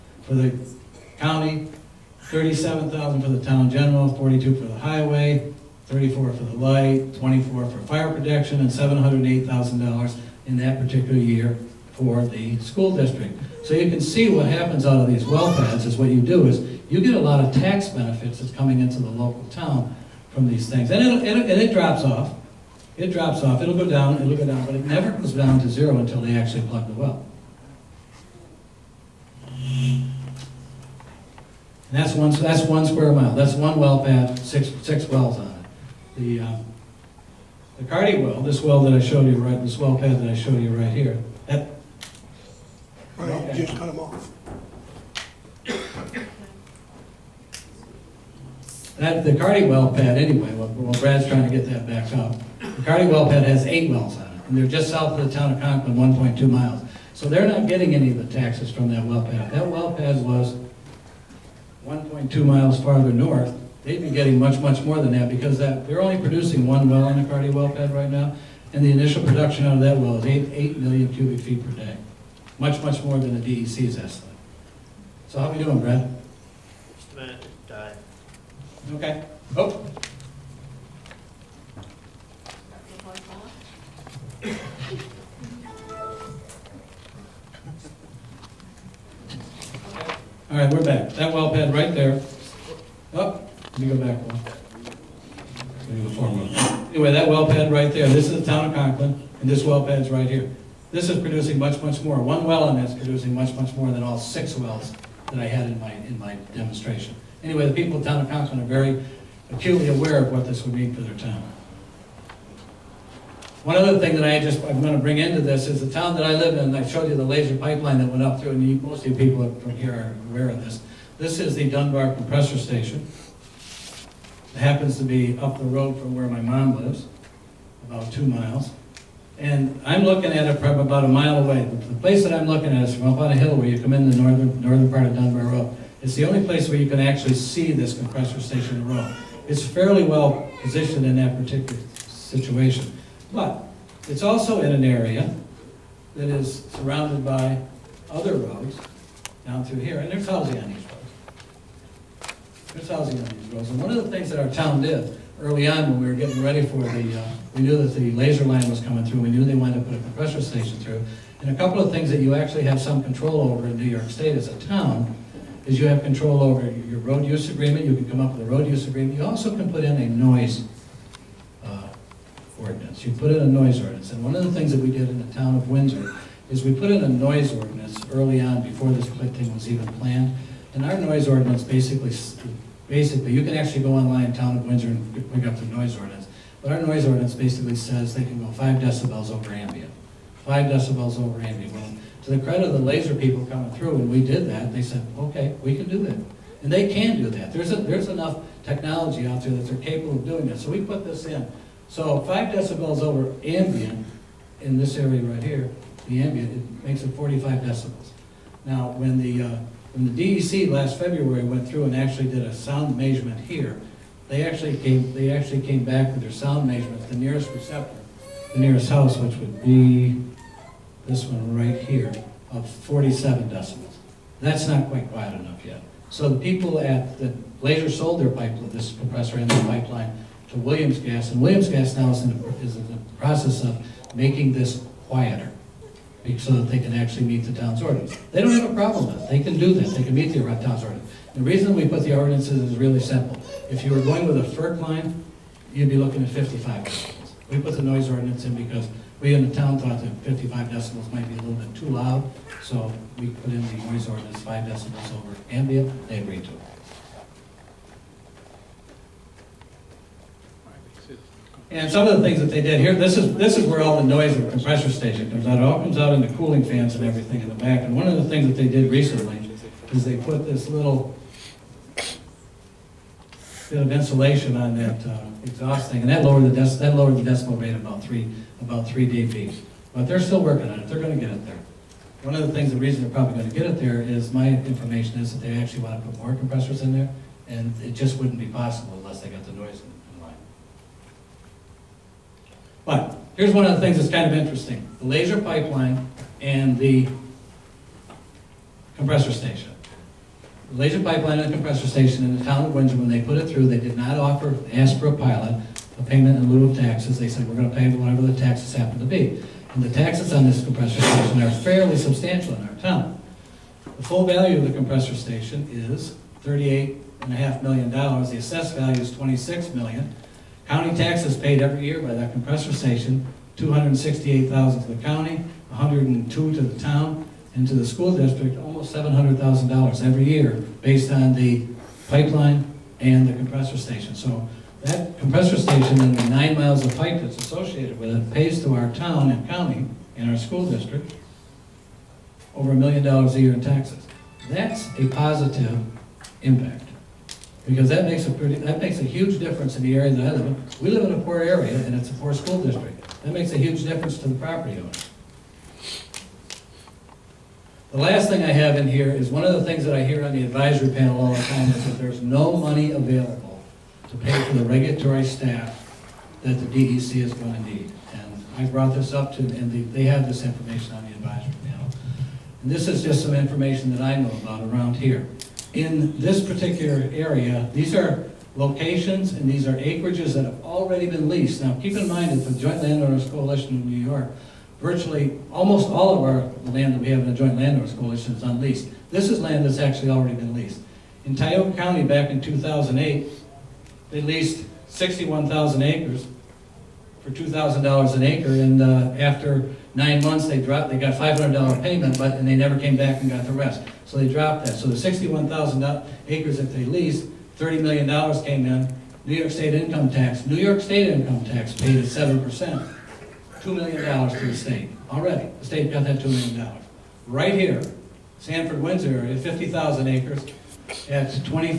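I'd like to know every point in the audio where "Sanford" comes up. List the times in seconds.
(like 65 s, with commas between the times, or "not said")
418 s.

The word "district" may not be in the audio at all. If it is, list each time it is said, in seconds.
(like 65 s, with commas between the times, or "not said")
12 s, 328 s, 340 s, 352 s.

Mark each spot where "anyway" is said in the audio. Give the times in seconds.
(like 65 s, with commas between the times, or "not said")
50 s, 96 s, 107 s.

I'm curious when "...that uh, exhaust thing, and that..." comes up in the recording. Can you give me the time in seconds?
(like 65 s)
274 s.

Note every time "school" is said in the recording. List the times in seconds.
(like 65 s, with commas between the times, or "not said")
12 s, 327 s, 340 s, 352 s.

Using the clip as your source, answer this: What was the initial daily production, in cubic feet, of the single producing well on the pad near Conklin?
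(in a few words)
8 million.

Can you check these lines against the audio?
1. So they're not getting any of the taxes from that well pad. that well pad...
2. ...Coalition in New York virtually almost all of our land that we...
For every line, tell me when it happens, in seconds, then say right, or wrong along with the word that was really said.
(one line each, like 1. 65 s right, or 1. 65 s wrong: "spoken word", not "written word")
1. 57 s right
2. 383 s right.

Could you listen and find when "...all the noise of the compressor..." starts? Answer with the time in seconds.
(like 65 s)
263 s.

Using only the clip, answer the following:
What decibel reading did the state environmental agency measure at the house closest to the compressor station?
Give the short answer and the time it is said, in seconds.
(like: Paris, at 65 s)
47 decibels, at 222 s.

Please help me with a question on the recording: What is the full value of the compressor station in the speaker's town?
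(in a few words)
$38.5 million.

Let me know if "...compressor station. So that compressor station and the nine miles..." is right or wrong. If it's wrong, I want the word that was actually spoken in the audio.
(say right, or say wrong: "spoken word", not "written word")
right.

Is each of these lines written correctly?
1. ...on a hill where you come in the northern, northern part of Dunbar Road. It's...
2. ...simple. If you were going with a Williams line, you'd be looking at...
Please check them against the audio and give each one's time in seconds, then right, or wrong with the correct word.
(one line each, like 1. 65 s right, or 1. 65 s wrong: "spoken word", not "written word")
1. 133 s right
2. 243 s wrong: "FERC", not "Williams".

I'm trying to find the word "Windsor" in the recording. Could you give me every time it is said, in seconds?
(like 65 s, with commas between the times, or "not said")
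175 s, 184 s, 302 s, 418 s.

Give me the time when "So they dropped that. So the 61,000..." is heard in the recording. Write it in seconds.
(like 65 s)
404 s.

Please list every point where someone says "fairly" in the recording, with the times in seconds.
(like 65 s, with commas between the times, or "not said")
139 s, 311 s.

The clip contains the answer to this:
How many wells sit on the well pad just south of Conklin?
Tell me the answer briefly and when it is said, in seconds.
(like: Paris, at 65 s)
8, at 53 s.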